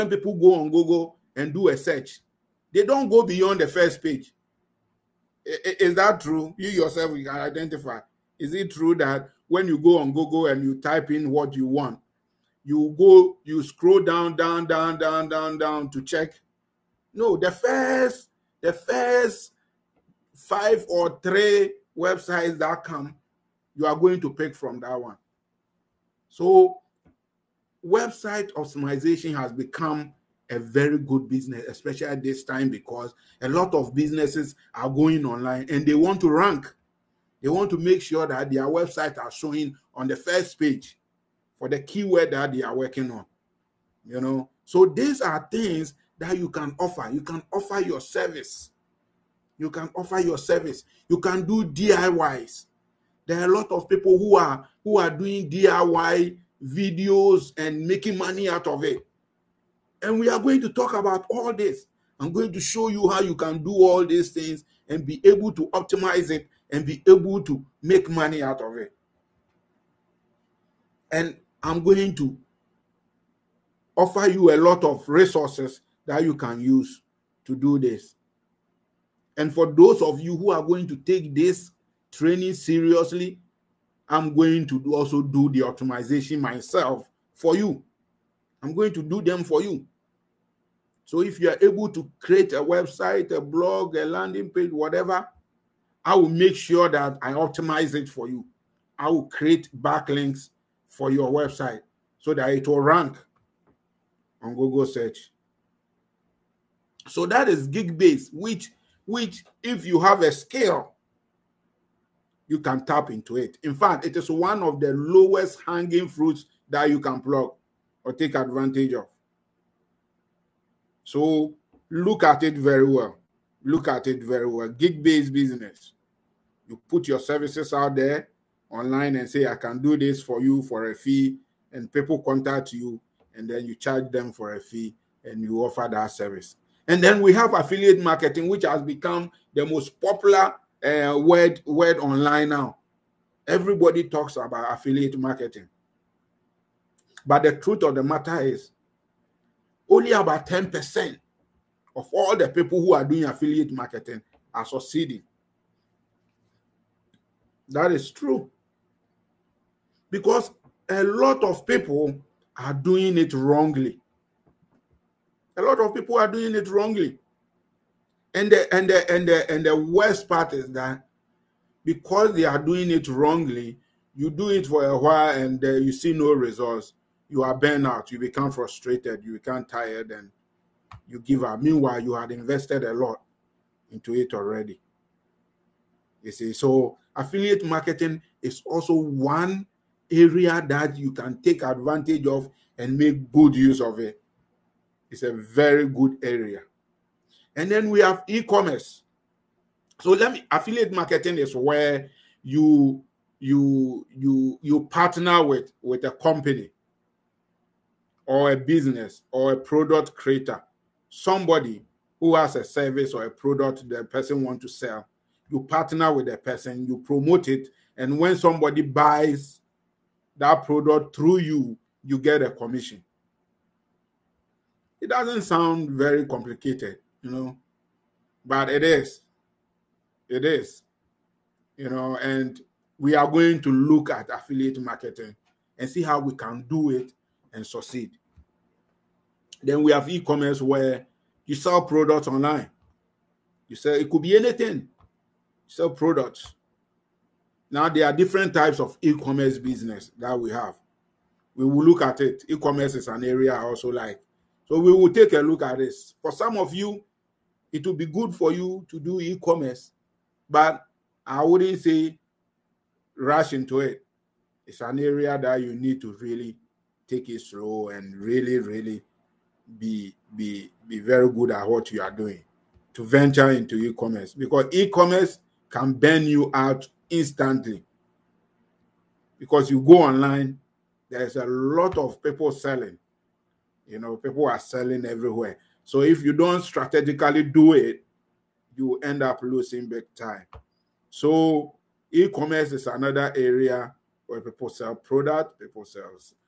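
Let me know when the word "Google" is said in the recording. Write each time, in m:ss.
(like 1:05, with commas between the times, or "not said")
0:00, 0:10, 1:44.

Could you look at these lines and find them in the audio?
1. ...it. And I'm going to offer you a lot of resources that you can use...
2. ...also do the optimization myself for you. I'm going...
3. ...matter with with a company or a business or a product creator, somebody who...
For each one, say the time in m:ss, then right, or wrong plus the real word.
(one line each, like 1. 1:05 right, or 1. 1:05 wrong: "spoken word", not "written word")
1. 1:08 right
2. 1:24 right
3. 3:24 wrong: "partner", not "matter".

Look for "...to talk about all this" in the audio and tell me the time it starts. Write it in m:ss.
1:00.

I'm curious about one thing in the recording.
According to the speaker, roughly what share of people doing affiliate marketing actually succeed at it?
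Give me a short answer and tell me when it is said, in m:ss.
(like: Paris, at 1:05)
10%, at 2:30.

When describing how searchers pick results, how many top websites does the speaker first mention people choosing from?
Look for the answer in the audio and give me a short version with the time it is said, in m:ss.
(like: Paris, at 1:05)
5, at 0:20.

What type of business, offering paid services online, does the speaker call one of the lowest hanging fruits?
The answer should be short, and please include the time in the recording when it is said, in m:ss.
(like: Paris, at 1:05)
Gig based business, at 1:47.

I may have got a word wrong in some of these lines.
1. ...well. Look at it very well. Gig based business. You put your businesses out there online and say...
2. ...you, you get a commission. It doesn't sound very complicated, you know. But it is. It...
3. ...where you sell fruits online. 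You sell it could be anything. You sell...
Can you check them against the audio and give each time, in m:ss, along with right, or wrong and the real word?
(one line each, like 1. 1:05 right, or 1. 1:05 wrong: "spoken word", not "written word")
1. 2:02 wrong: "services", not "businesses"
2. 3:41 right
3. 4:00 wrong: "products", not "fruits".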